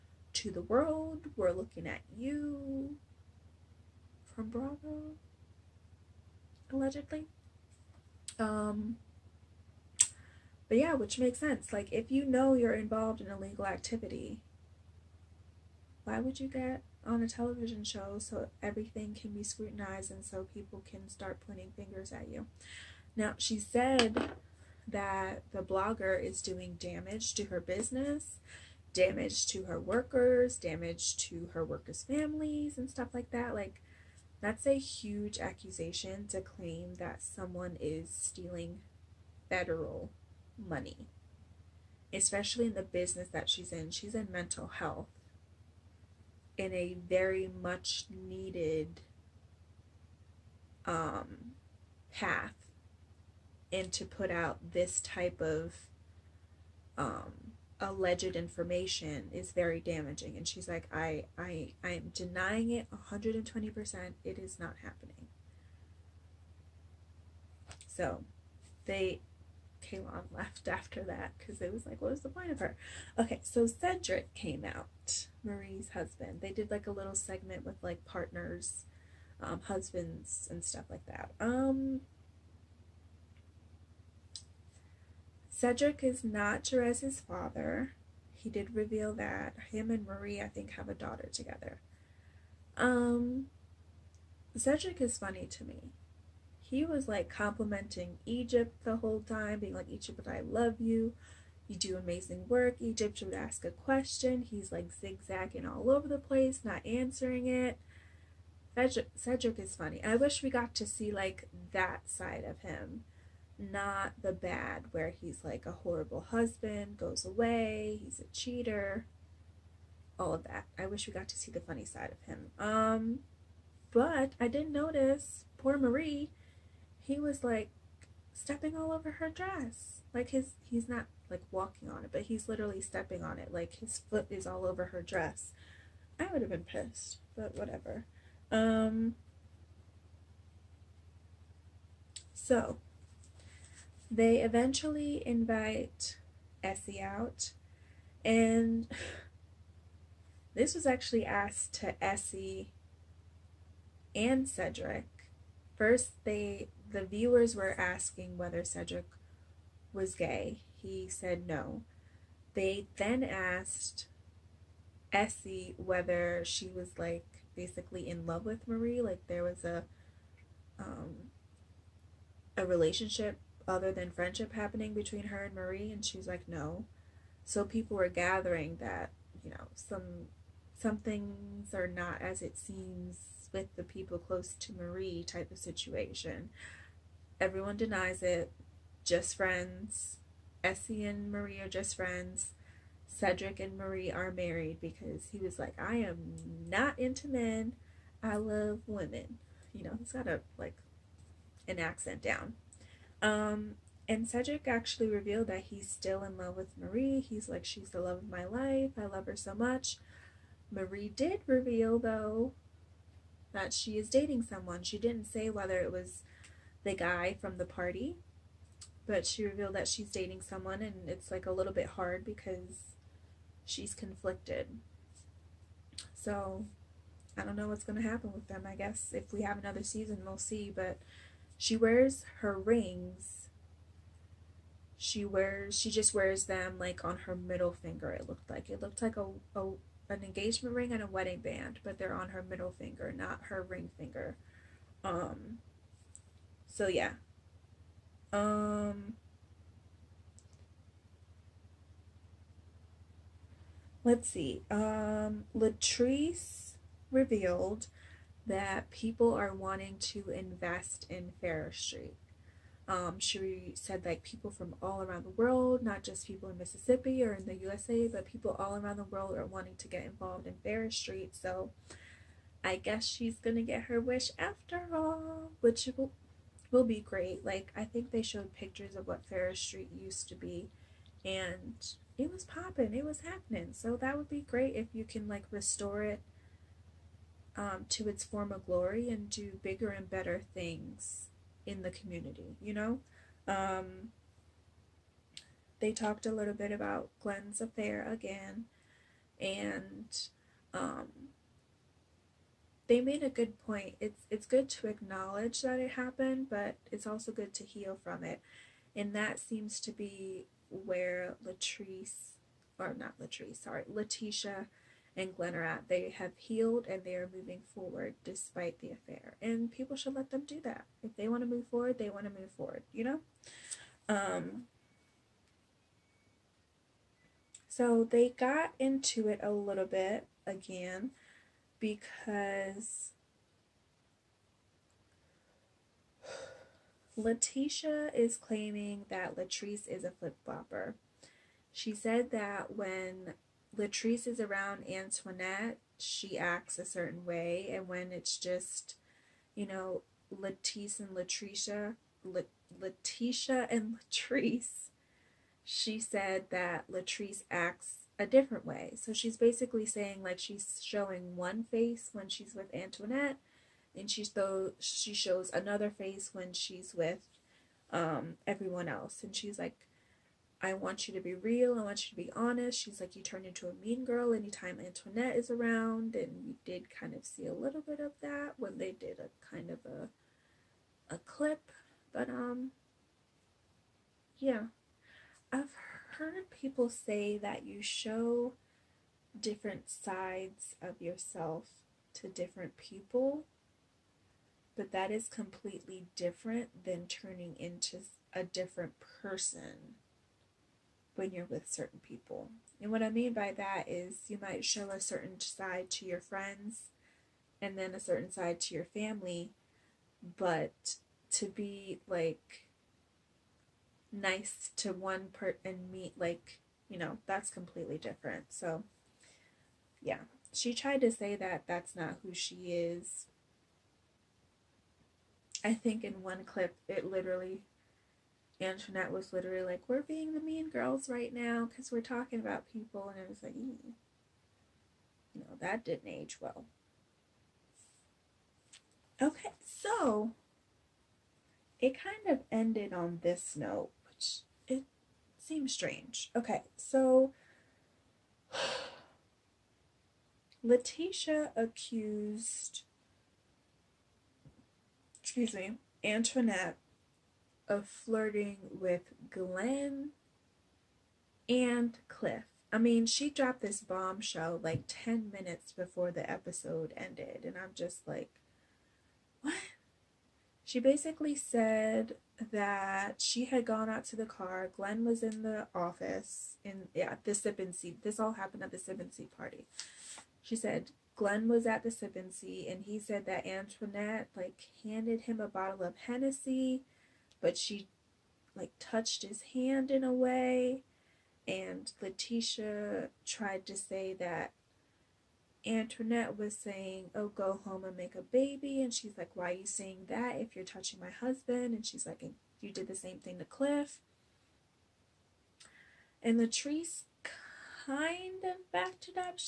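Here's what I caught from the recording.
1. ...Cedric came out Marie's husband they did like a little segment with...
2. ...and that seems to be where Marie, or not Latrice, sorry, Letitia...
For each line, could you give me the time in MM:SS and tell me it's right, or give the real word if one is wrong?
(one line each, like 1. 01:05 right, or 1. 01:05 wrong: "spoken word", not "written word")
1. 01:13 right
2. 05:08 wrong: "Latrice", not "Marie".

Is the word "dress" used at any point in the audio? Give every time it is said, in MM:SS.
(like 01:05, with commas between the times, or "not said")
02:09, 02:15.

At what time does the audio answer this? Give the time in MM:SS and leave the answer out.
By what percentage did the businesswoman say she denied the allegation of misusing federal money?
01:02.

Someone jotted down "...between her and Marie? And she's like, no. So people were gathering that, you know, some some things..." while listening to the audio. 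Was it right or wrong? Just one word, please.
right.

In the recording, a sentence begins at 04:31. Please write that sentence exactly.
So I guess she's gonna get her wish after all, which will, will be great.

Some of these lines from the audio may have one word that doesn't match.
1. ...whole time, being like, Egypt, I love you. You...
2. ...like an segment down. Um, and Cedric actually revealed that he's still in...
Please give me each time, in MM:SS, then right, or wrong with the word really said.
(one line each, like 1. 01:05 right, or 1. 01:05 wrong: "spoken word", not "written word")
1. 01:38 right
2. 03:20 wrong: "accent", not "segment".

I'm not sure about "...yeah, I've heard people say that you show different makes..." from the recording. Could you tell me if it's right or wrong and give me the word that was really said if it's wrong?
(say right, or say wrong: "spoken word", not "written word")
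wrong: "sides", not "makes".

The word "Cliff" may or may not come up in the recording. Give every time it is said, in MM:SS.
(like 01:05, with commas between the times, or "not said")
07:42, 08:23.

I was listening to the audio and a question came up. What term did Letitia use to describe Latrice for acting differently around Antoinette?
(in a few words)
Flip flopper.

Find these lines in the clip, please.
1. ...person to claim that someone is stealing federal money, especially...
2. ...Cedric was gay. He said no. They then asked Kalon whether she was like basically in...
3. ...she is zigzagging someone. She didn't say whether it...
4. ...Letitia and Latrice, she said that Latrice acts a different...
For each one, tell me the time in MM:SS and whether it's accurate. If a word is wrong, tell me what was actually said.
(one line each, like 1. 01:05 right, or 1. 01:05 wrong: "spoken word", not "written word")
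1. 00:35 wrong: "accusation", not "person"
2. 02:38 wrong: "Essie", not "Kalon"
3. 03:33 wrong: "dating", not "zigzagging"
4. 05:52 right.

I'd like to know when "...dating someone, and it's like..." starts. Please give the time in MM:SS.
03:40.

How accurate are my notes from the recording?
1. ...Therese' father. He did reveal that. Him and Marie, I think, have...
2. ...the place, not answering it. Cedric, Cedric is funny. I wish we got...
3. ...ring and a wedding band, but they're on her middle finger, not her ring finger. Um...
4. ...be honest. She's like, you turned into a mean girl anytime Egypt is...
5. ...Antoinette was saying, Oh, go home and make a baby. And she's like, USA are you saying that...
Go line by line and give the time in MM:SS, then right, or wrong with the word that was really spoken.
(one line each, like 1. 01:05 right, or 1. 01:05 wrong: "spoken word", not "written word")
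1. 01:26 right
2. 01:46 right
3. 04:00 right
4. 06:12 wrong: "Antoinette", not "Egypt"
5. 08:15 wrong: "Why", not "USA".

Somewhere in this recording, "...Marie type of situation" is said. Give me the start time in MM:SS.
03:04.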